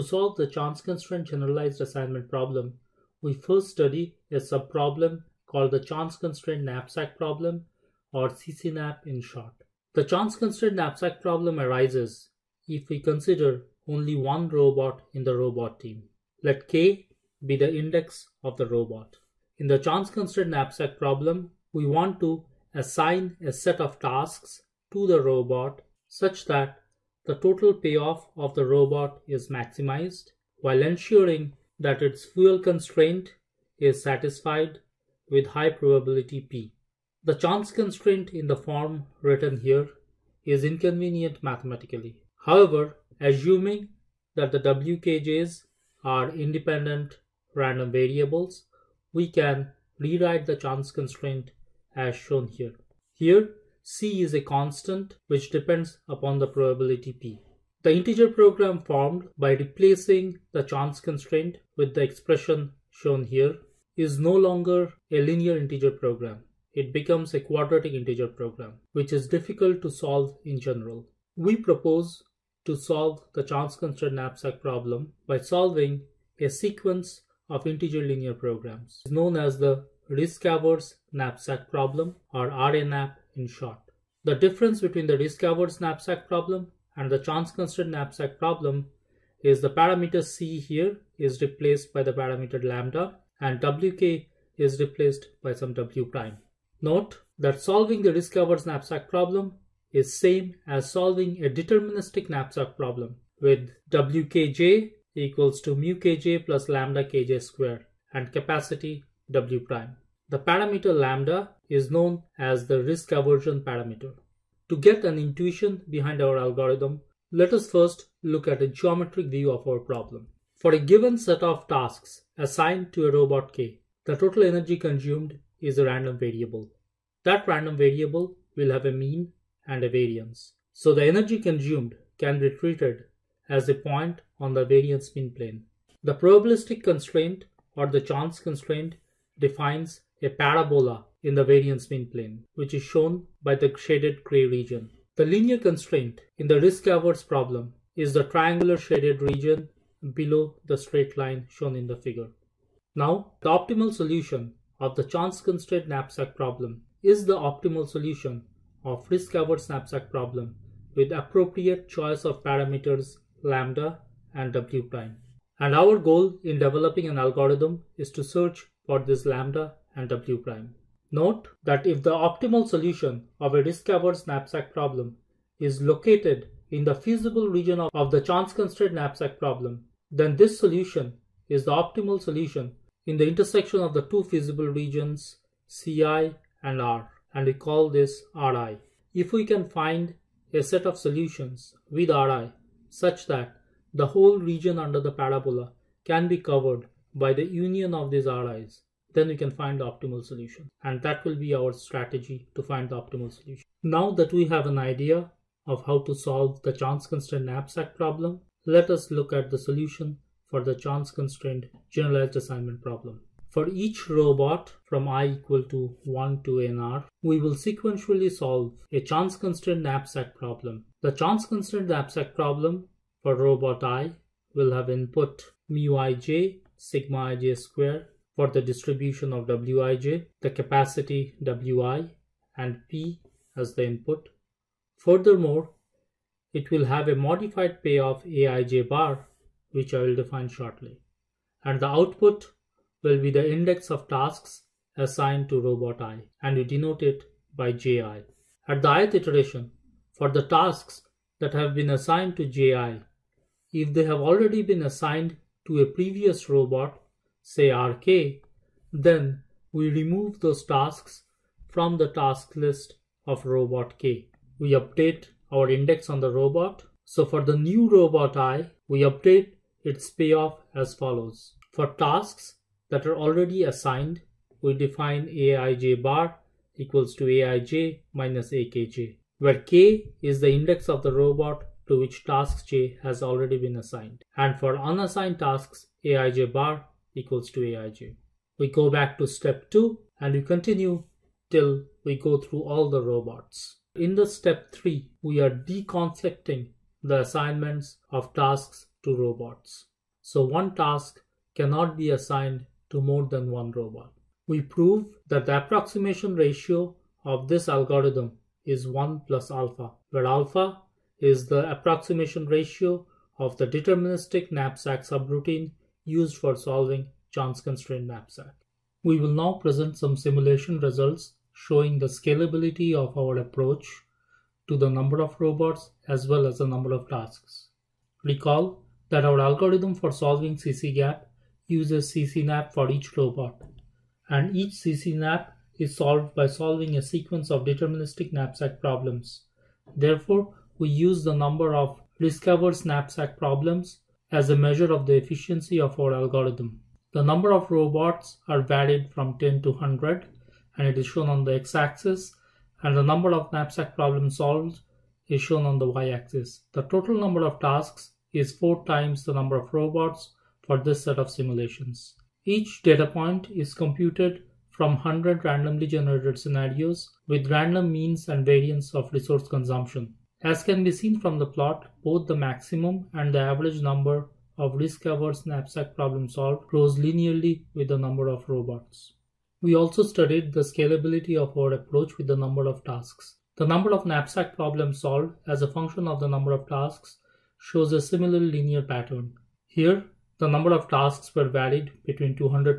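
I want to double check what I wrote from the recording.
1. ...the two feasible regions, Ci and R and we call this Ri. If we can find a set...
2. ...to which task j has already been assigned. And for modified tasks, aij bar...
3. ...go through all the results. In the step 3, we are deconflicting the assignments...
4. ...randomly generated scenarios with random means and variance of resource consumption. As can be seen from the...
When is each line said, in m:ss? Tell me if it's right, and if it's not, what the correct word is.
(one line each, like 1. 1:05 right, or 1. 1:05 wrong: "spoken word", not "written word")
1. 3:03 right
2. 4:41 wrong: "unassigned", not "modified"
3. 4:52 wrong: "robots", not "results"
4. 6:05 right.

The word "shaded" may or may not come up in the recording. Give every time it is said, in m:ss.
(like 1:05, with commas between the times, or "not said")
2:23, 2:28.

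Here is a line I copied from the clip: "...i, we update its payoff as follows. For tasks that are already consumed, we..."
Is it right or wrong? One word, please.
wrong.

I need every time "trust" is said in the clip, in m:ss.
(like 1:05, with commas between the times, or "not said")
not said.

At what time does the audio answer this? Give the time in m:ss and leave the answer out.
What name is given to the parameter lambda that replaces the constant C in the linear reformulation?
1:52.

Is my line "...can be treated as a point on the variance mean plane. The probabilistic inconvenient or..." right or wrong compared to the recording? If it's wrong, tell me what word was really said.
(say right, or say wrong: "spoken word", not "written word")
wrong: "constraint", not "inconvenient".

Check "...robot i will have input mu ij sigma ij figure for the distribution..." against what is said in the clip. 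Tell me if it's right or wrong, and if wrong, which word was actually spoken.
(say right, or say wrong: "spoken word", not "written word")
wrong: "square", not "figure".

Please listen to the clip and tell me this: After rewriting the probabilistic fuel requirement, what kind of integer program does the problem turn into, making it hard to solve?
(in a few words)
quadratic integer program.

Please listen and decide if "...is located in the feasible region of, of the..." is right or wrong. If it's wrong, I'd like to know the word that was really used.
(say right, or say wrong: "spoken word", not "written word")
right.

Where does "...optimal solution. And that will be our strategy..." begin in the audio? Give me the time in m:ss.
3:19.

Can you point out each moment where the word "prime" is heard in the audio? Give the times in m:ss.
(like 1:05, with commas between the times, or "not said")
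1:36, 1:49, 2:44, 2:50.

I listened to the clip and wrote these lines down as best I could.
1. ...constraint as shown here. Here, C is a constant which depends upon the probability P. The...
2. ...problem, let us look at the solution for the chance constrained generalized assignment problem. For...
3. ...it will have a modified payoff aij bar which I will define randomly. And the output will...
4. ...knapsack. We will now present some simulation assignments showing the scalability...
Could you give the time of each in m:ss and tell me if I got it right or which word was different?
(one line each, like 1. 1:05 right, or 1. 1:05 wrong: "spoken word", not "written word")
1. 0:50 right
2. 3:27 right
3. 3:56 wrong: "shortly", not "randomly"
4. 5:18 wrong: "results", not "assignments".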